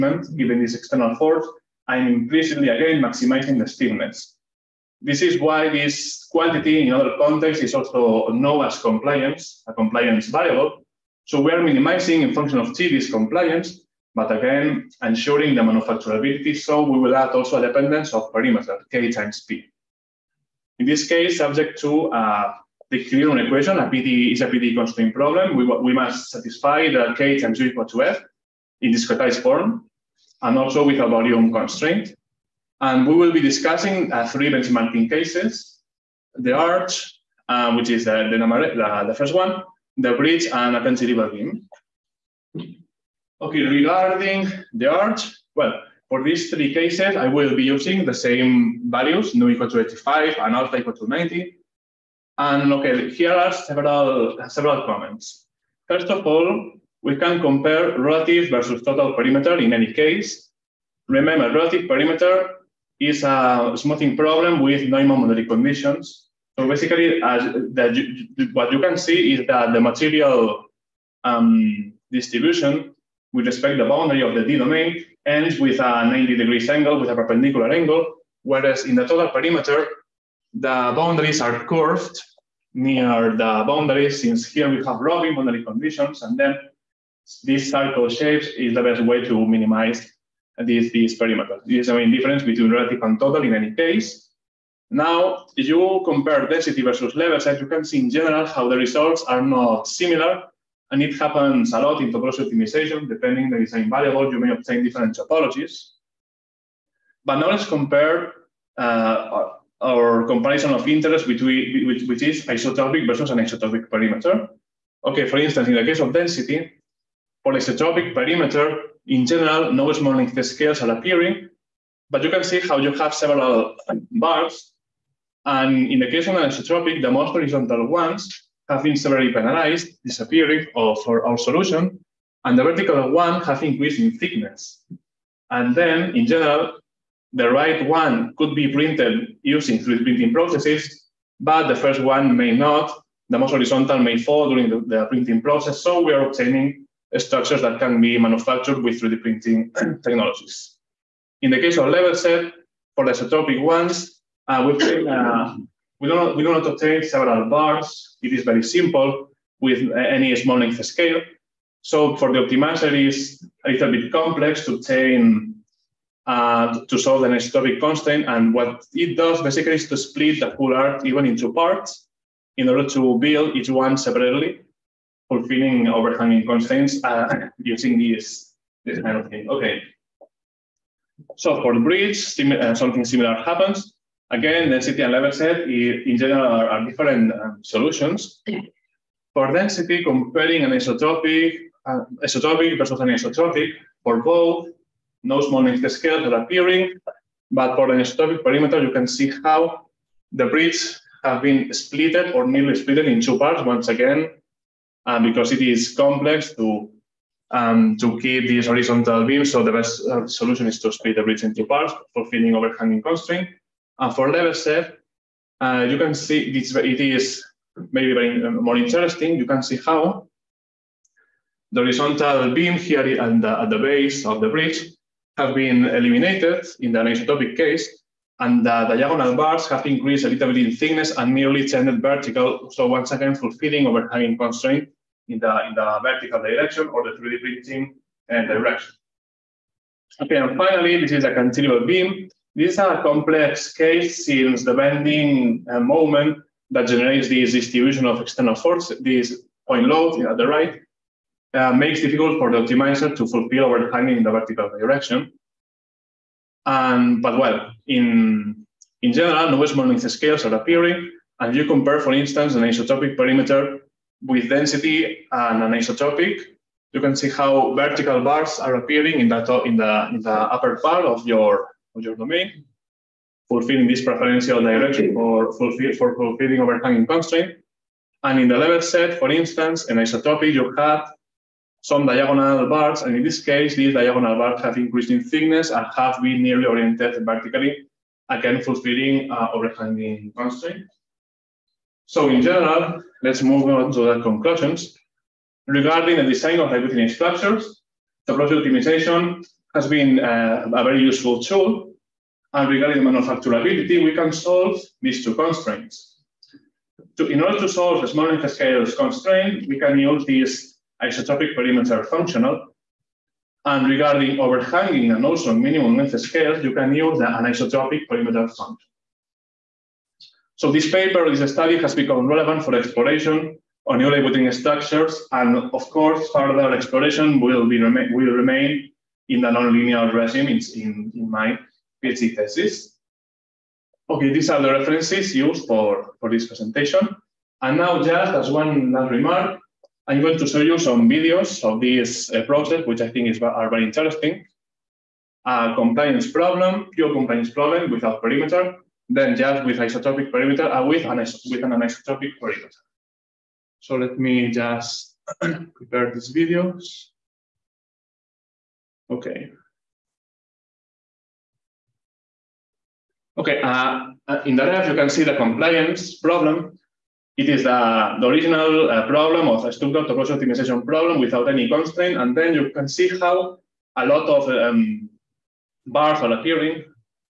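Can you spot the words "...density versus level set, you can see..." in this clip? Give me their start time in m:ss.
1:36.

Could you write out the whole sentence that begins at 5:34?
Okay, these are the references used for, for this presentation.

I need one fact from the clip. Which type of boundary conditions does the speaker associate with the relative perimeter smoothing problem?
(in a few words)
Neumann.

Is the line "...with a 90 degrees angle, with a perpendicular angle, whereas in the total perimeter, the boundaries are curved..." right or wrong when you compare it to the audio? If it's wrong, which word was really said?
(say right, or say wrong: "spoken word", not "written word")
right.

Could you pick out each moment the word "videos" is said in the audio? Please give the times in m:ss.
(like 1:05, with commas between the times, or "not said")
5:41, 5:56.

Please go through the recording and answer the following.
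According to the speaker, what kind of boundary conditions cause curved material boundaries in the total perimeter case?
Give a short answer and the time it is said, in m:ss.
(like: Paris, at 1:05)
Robin boundary conditions, at 1:24.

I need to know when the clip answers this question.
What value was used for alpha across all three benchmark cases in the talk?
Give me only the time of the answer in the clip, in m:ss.
0:50.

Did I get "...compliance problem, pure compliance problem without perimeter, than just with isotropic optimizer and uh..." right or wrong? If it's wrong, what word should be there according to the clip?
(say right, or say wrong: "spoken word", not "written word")
wrong: "perimeter", not "optimizer".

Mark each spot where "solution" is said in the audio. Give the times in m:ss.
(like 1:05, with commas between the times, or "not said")
2:11, 3:07, 3:30.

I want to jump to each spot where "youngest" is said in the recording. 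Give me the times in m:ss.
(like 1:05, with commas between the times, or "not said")
not said.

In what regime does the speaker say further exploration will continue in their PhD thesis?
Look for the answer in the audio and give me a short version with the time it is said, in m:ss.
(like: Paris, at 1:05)
nonlinear regime, at 5:29.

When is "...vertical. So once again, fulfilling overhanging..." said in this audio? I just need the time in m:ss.
3:52.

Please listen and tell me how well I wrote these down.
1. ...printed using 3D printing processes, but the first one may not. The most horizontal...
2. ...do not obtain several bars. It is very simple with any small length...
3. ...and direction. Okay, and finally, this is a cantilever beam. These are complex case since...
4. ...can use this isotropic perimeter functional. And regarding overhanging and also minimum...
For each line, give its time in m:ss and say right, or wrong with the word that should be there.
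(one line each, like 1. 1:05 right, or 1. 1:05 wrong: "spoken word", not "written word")
1. 2:18 right
2. 2:36 right
3. 3:58 right
4. 5:09 right.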